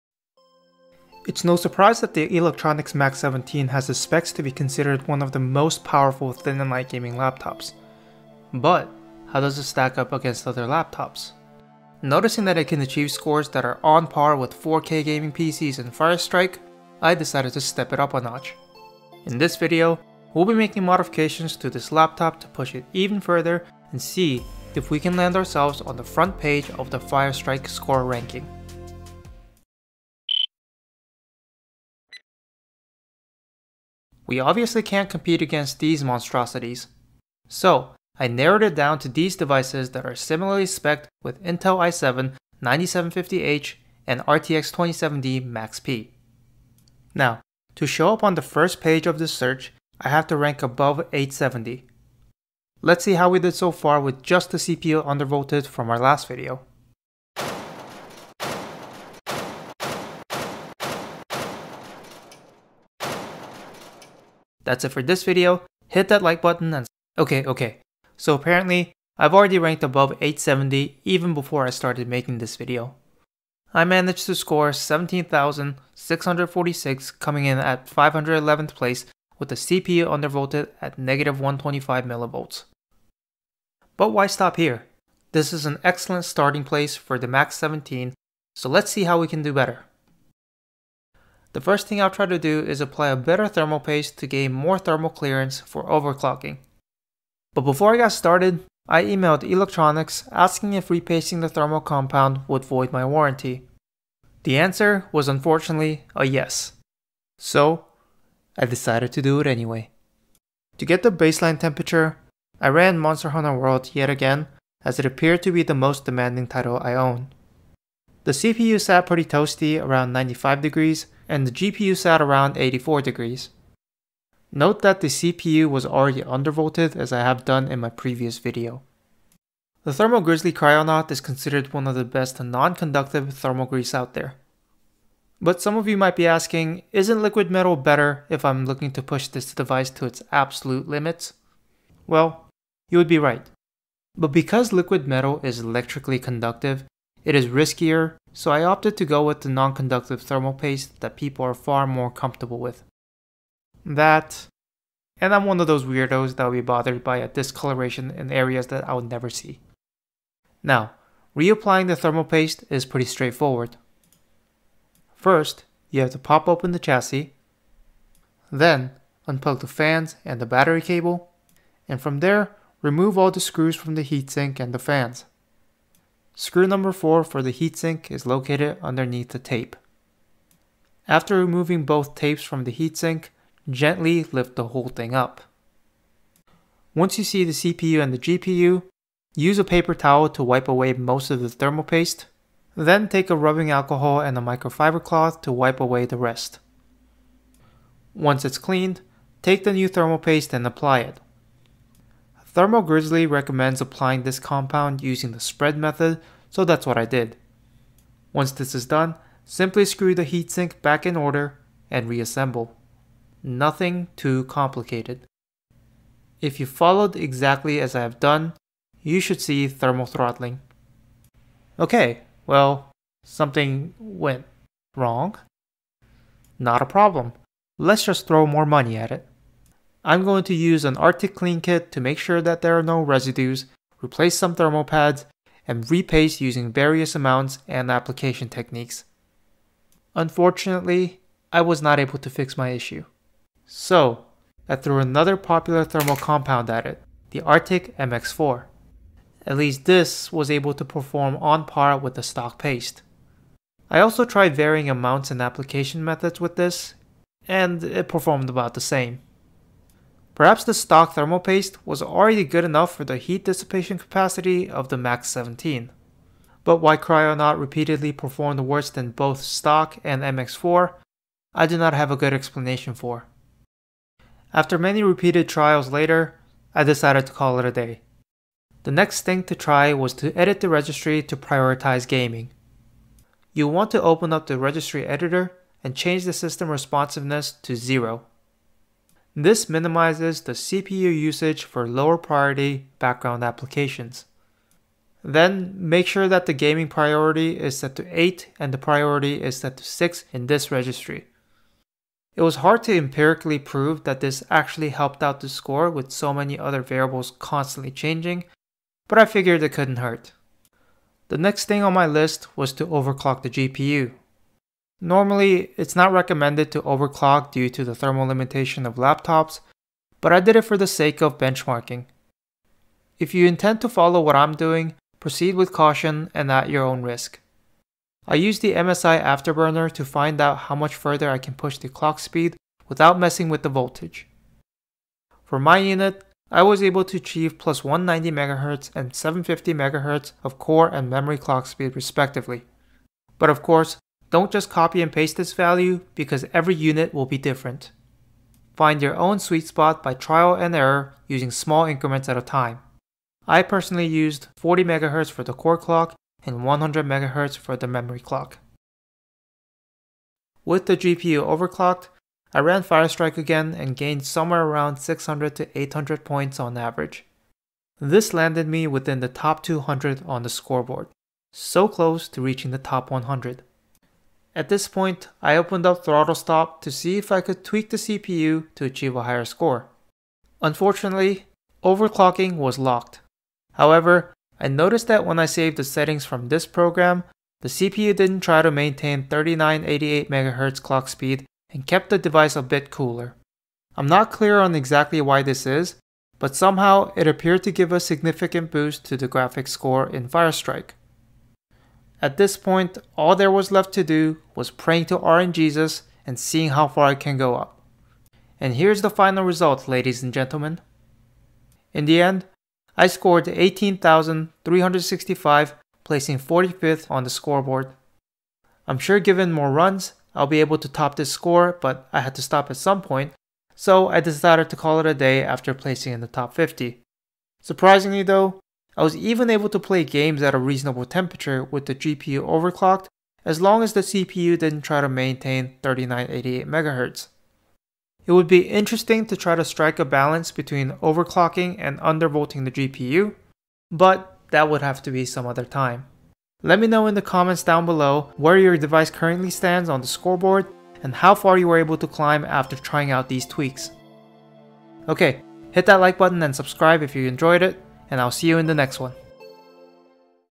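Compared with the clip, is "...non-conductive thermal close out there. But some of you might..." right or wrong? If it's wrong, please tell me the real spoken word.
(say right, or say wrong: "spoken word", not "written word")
wrong: "grease", not "close".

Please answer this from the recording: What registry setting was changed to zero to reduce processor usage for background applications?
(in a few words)
system responsiveness.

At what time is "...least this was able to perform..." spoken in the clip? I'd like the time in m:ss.
4:09.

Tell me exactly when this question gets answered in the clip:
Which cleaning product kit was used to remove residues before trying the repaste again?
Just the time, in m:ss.
3:50.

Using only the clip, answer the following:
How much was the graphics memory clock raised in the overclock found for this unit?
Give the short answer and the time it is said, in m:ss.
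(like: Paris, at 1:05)
750 MHz, at 5:39.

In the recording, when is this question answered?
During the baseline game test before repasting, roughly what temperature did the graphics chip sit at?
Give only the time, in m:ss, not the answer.
2:02.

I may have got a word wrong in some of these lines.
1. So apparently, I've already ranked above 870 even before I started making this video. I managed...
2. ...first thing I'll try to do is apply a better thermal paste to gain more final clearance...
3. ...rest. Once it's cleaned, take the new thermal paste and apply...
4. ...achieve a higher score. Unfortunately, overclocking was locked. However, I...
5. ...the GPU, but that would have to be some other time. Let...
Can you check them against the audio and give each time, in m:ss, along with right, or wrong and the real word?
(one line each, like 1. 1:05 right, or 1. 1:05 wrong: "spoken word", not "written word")
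1. 1:08 right
2. 1:31 wrong: "thermal", not "final"
3. 3:16 right
4. 6:18 right
5. 7:22 right.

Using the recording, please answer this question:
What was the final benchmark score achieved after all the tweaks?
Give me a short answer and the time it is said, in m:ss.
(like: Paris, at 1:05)
18,365, at 6:53.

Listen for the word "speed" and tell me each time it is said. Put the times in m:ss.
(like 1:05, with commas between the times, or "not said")
5:32, 5:41, 6:31.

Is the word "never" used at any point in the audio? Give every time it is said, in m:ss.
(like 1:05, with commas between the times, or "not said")
2:39.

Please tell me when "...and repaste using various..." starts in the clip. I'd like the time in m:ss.
3:55.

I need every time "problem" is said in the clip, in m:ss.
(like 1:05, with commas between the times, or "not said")
3:46.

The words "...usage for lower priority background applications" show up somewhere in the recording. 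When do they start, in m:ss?
4:51.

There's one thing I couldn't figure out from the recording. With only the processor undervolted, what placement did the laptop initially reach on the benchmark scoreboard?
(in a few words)
511th.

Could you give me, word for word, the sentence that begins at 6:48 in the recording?
And here's the final result, ladies and gentlemen.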